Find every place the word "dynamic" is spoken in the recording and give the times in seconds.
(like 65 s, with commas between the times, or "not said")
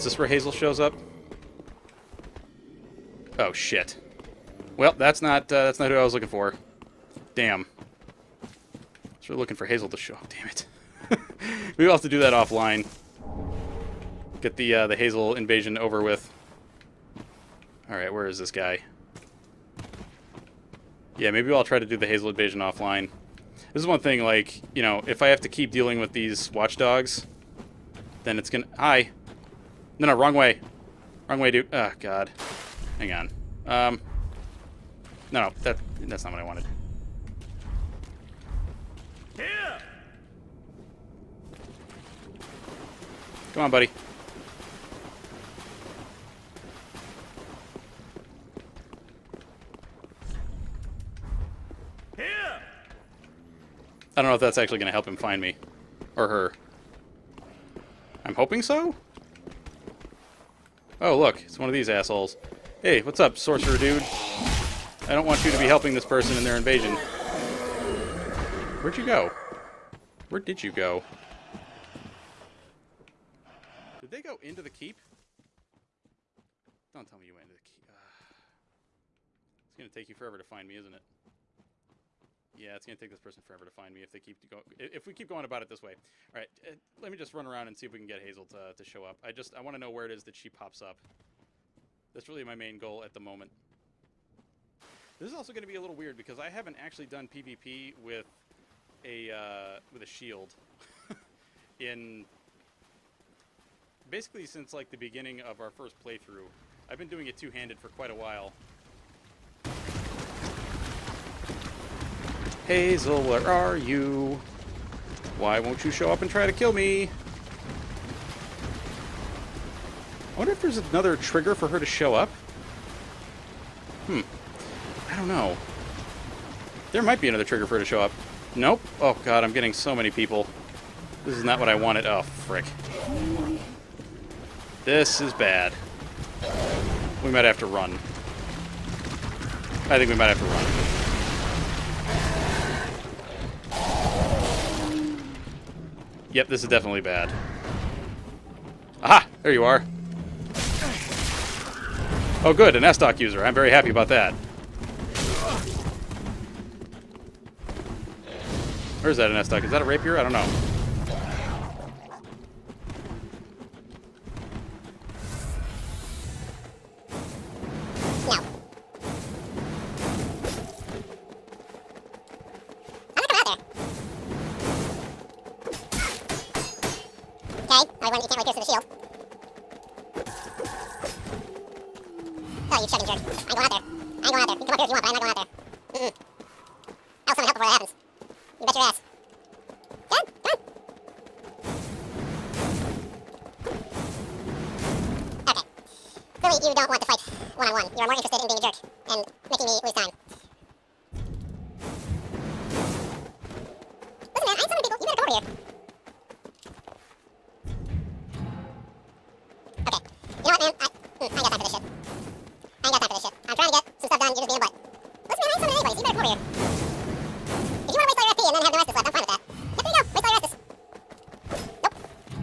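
not said.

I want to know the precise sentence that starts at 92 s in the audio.
That's really my main goal at the moment.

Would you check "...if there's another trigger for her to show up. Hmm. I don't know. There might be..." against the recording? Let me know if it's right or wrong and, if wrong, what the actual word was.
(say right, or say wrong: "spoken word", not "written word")
right.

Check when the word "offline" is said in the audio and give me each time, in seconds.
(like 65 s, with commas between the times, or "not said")
12 s, 22 s.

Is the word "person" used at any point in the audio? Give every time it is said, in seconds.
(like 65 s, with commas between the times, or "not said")
66 s, 83 s.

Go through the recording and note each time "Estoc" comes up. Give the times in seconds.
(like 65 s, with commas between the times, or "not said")
152 s, 159 s.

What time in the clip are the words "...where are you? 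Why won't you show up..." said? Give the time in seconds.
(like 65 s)
113 s.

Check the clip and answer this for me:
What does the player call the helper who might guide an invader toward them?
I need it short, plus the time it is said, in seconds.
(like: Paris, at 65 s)
sorcerer dude, at 63 s.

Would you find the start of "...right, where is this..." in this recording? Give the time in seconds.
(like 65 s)
17 s.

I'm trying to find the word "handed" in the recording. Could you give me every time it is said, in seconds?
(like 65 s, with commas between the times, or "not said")
107 s.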